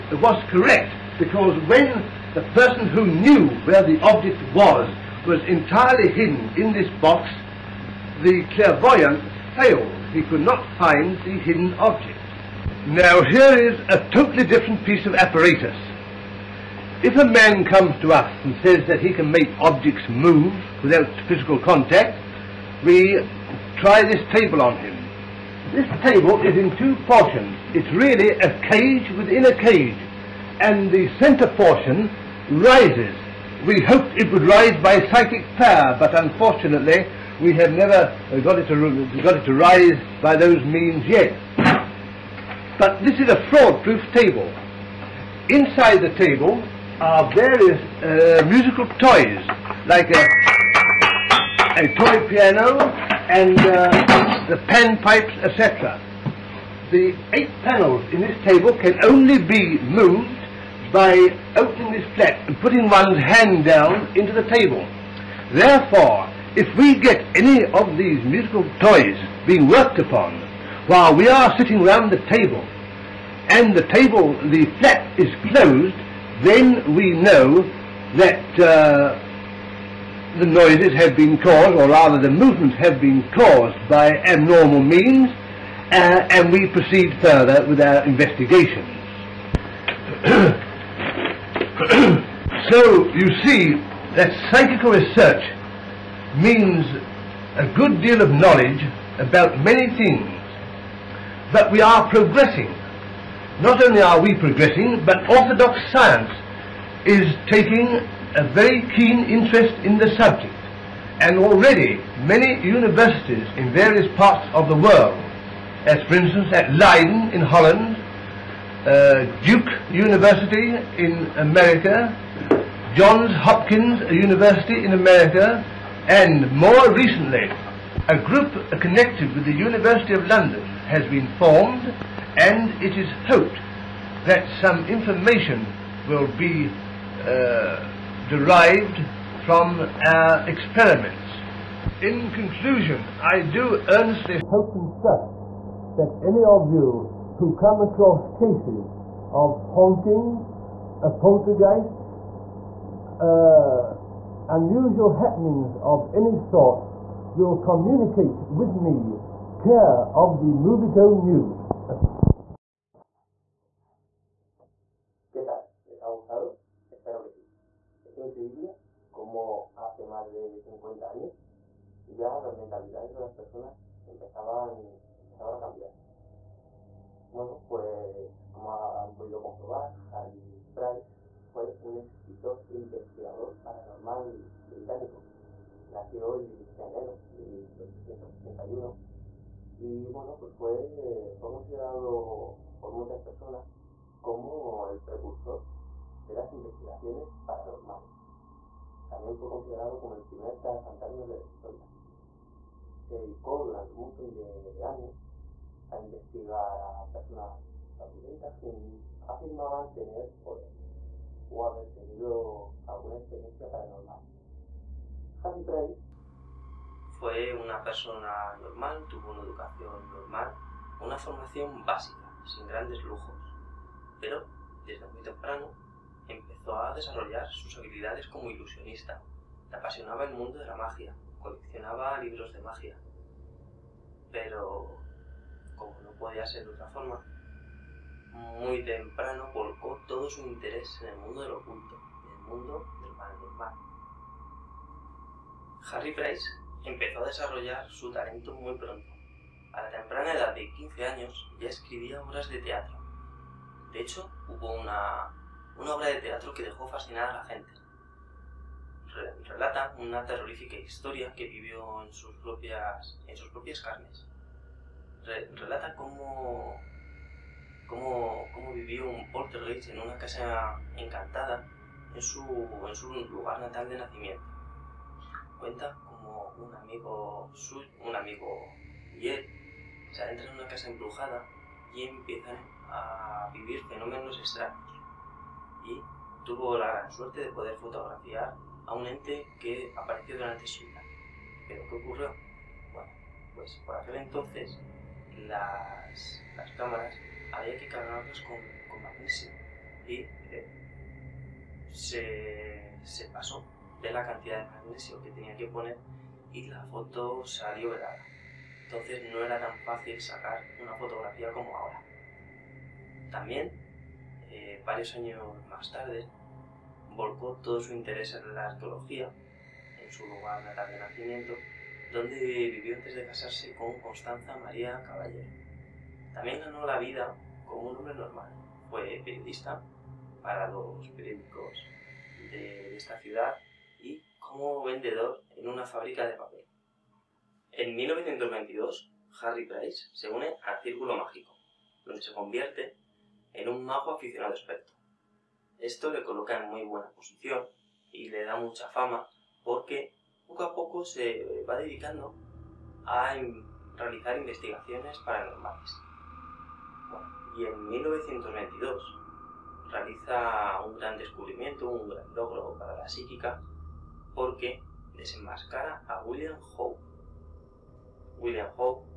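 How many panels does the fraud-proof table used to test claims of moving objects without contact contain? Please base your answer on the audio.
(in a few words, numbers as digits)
8.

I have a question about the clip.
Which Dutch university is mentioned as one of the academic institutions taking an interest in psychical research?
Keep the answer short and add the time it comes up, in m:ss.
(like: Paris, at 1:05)
Leiden, at 1:56.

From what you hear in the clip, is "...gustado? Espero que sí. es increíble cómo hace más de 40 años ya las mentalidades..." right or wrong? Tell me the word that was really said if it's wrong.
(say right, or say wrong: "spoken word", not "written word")
wrong: "50", not "40".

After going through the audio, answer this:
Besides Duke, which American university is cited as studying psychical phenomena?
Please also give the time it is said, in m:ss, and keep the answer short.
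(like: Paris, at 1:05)
Johns Hopkins University, at 2:02.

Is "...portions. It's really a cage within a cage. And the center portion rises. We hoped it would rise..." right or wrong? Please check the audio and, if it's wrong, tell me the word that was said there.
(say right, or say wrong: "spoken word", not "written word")
right.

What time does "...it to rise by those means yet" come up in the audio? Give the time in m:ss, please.
0:39.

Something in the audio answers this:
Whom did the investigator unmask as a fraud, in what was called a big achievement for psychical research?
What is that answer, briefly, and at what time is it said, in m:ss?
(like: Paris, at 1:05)
William Howe, at 6:06.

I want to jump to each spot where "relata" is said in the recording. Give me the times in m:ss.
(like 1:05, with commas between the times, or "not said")
4:19, 4:25.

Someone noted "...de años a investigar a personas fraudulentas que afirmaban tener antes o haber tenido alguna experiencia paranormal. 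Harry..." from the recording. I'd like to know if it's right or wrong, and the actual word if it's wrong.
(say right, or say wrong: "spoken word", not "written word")
wrong: "poderes", not "antes".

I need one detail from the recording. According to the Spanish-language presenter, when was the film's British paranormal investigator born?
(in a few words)
16 January 1881.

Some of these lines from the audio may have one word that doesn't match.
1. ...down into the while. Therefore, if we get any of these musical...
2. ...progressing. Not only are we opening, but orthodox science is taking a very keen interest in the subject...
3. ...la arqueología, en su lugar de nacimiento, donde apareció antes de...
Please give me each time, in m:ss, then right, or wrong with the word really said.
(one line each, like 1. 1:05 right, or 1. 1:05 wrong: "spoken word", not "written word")
1. 1:03 wrong: "table", not "while"
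2. 1:42 wrong: "progressing", not "opening"
3. 5:18 wrong: "vivió", not "apareció".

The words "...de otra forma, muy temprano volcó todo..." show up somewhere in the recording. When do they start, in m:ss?
3:56.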